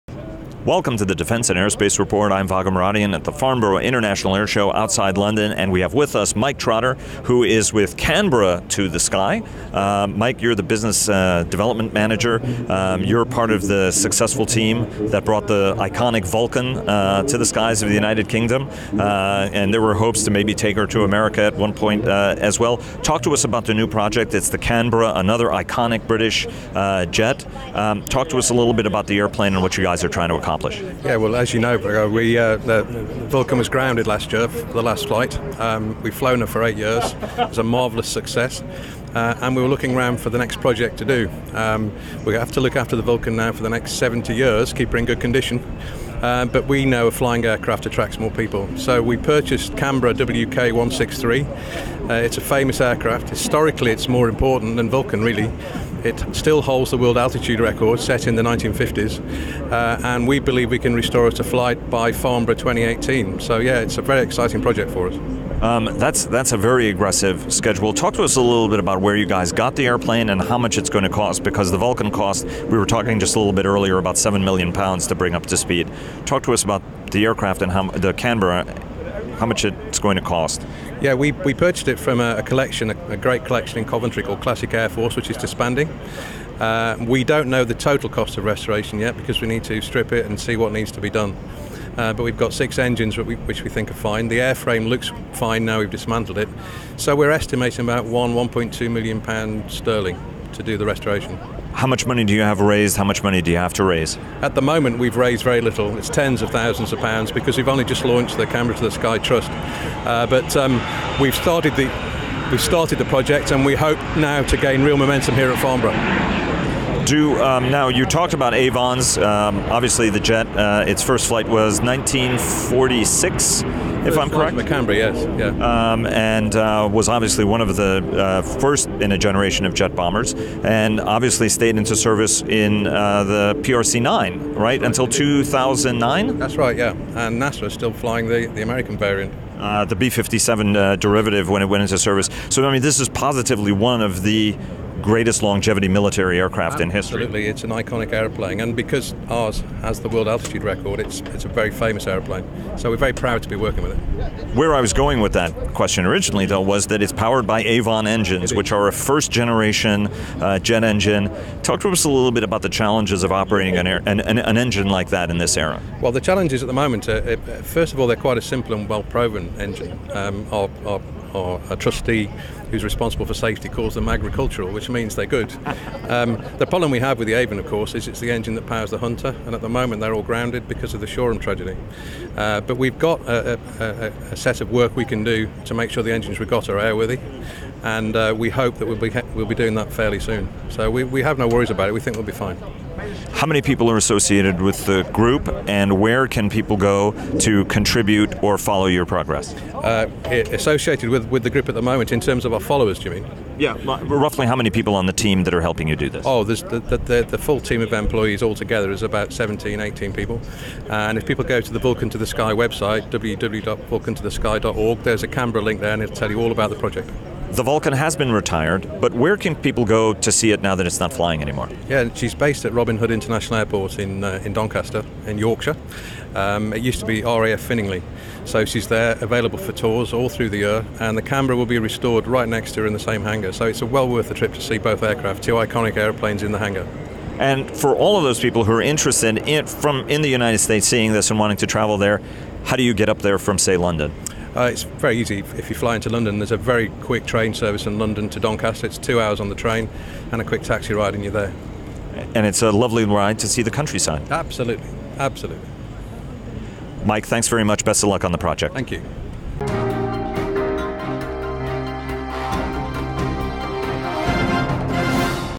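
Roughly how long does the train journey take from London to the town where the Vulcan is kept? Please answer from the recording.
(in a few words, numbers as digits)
2 hours.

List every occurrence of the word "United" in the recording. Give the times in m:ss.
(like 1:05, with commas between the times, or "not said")
0:17, 4:00.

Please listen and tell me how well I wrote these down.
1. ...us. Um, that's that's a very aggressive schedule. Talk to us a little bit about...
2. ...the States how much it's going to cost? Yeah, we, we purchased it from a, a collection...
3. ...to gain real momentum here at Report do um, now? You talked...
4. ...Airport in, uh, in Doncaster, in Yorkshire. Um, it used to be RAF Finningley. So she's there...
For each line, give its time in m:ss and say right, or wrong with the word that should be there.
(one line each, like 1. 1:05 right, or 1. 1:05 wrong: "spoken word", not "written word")
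1. 1:05 right
2. 1:17 wrong: "Canberra", not "States"
3. 1:54 wrong: "Farnborough", not "Report"
4. 3:43 right.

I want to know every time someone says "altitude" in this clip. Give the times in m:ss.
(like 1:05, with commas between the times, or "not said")
0:57, 2:30.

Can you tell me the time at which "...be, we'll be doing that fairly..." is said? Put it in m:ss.
3:08.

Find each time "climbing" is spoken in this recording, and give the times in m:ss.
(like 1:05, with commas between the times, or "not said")
not said.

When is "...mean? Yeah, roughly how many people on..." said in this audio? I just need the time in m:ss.
3:23.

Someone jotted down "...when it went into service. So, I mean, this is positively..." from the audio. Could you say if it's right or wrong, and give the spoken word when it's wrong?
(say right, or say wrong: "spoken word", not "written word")
right.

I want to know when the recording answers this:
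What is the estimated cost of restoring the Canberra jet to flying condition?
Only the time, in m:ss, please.
1:38.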